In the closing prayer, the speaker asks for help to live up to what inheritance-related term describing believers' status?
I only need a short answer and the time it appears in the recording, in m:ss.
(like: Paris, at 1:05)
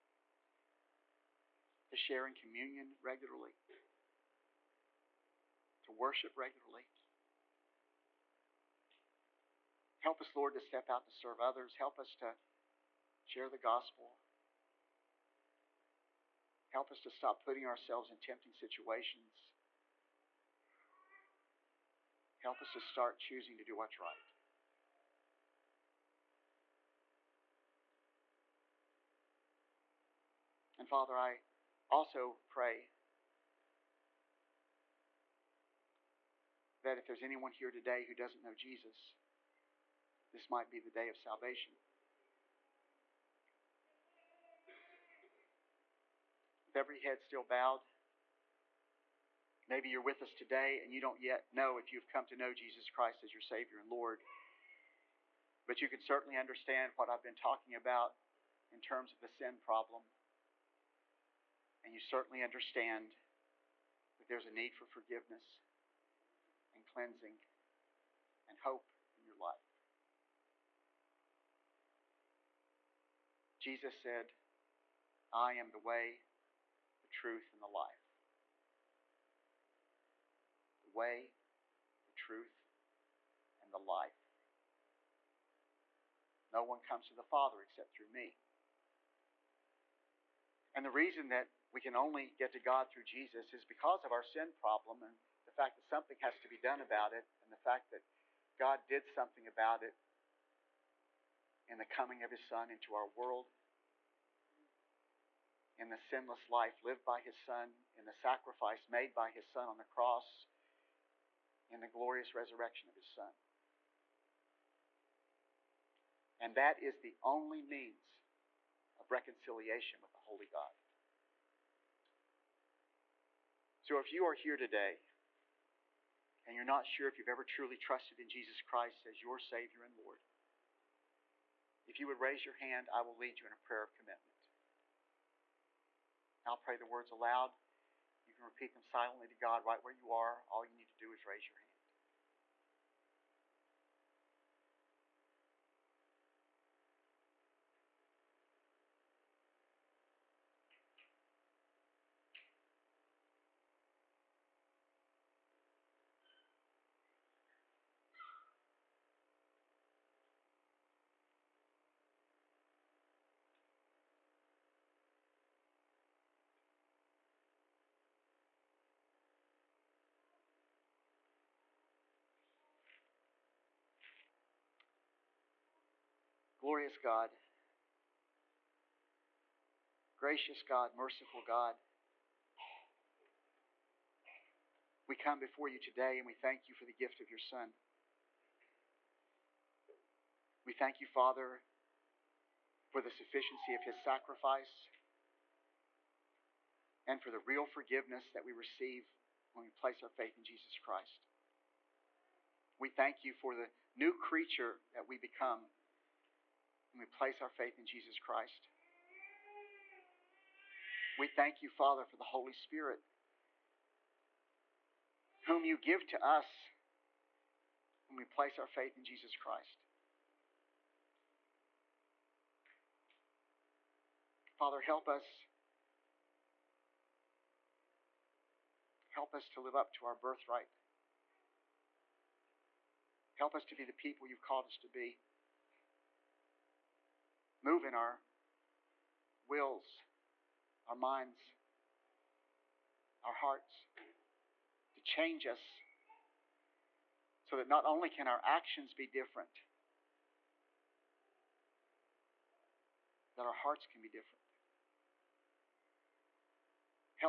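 birthright, at 3:50.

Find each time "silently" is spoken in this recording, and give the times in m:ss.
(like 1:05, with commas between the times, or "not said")
2:18.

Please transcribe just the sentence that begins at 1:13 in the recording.
Jesus said, I am the way, the truth, and the life.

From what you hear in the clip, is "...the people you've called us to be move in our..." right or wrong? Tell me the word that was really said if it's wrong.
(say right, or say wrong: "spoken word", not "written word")
right.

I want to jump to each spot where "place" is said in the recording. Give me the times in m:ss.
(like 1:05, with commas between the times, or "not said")
3:19, 3:27, 3:38.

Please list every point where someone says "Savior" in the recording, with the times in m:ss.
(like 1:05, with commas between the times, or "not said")
0:53, 2:09.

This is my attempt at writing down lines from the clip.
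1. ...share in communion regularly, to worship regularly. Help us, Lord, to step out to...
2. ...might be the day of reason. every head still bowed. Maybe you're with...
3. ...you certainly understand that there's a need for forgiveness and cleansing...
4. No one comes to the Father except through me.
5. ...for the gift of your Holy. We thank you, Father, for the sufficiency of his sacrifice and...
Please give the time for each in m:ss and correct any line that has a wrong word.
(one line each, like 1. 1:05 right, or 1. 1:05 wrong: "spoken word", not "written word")
1. 0:01 right
2. 0:40 wrong: "salvation", not "reason"
3. 1:01 right
4. 1:26 right
5. 3:06 wrong: "Son", not "Holy".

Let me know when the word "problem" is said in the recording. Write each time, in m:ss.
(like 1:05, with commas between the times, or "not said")
0:59, 1:34.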